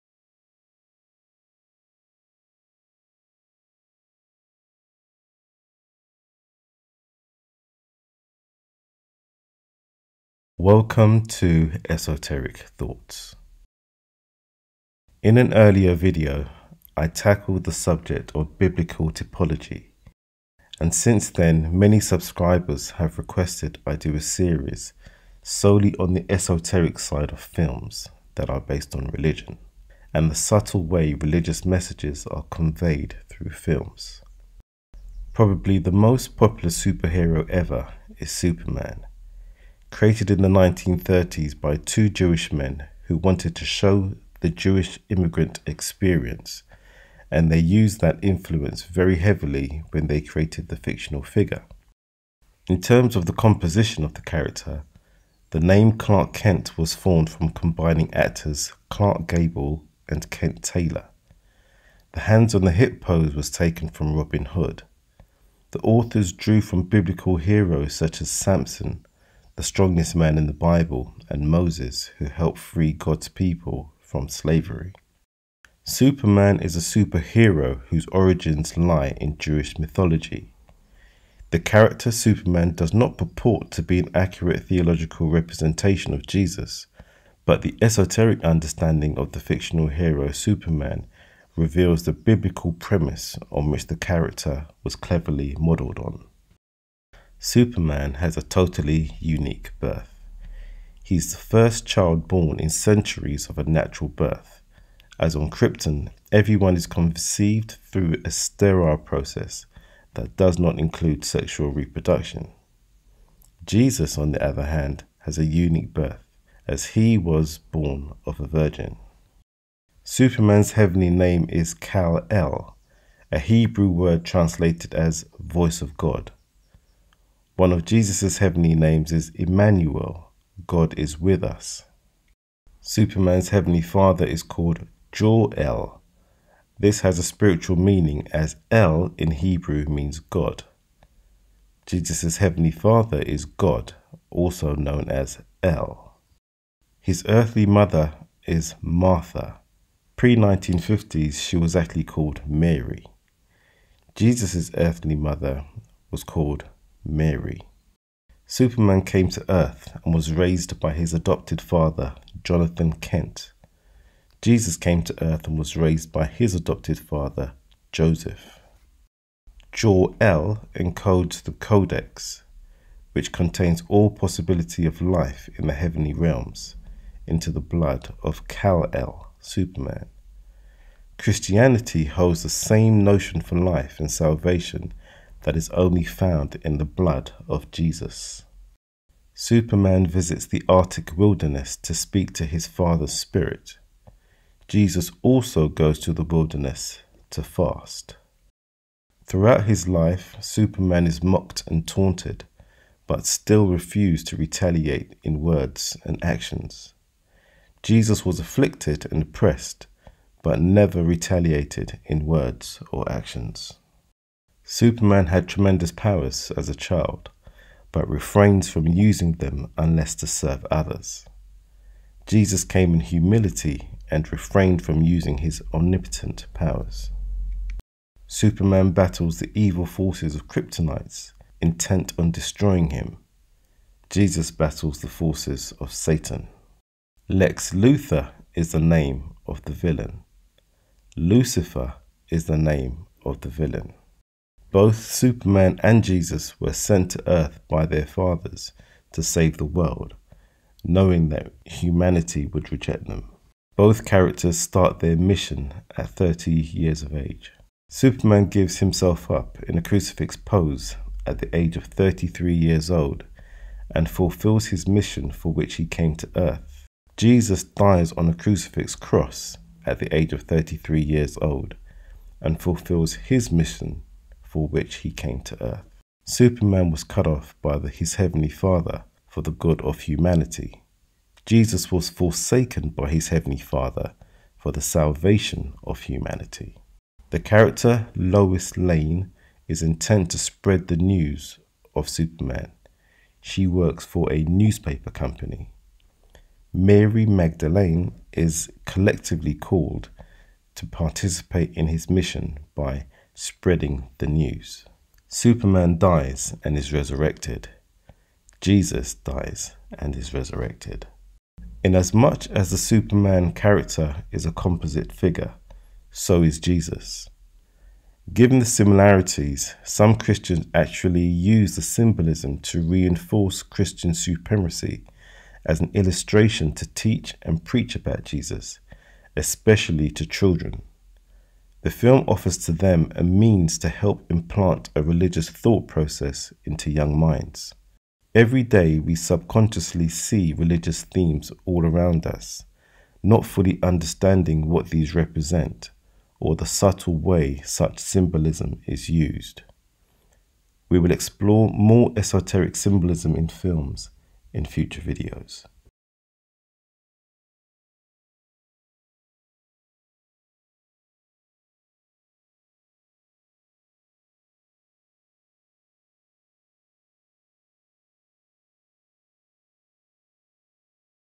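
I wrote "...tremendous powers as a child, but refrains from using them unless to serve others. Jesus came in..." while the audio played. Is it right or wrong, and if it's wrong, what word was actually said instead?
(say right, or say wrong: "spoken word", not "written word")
right.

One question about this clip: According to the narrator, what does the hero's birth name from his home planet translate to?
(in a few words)
voice of God.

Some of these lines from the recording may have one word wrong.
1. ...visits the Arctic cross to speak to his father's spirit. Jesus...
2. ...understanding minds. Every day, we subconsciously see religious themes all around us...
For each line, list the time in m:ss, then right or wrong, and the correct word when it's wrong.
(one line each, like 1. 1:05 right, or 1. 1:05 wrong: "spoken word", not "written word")
1. 3:10 wrong: "wilderness", not "cross"
2. 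5:36 wrong: "young", not "understanding".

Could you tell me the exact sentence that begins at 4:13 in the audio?
Both characters start their mission at 30 years of age.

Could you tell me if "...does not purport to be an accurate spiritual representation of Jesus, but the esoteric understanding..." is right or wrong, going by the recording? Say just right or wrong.
wrong.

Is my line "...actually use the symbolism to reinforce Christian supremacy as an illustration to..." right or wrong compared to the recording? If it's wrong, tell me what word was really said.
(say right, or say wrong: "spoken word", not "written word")
right.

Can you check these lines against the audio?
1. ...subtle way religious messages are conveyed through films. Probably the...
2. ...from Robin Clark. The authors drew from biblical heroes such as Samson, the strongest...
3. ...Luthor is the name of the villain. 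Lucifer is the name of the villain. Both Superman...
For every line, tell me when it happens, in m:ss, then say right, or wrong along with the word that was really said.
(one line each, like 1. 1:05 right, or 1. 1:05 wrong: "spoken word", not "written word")
1. 0:30 right
2. 1:03 wrong: "Hood", not "Clark"
3. 3:57 right.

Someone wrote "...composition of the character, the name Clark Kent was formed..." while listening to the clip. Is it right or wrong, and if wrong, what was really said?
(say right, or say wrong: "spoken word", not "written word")
right.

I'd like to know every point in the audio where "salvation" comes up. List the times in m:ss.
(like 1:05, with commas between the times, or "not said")
3:04, 4:44.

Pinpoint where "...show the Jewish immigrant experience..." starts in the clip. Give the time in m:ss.
0:43.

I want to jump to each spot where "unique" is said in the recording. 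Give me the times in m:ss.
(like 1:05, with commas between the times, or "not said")
1:39, 1:55.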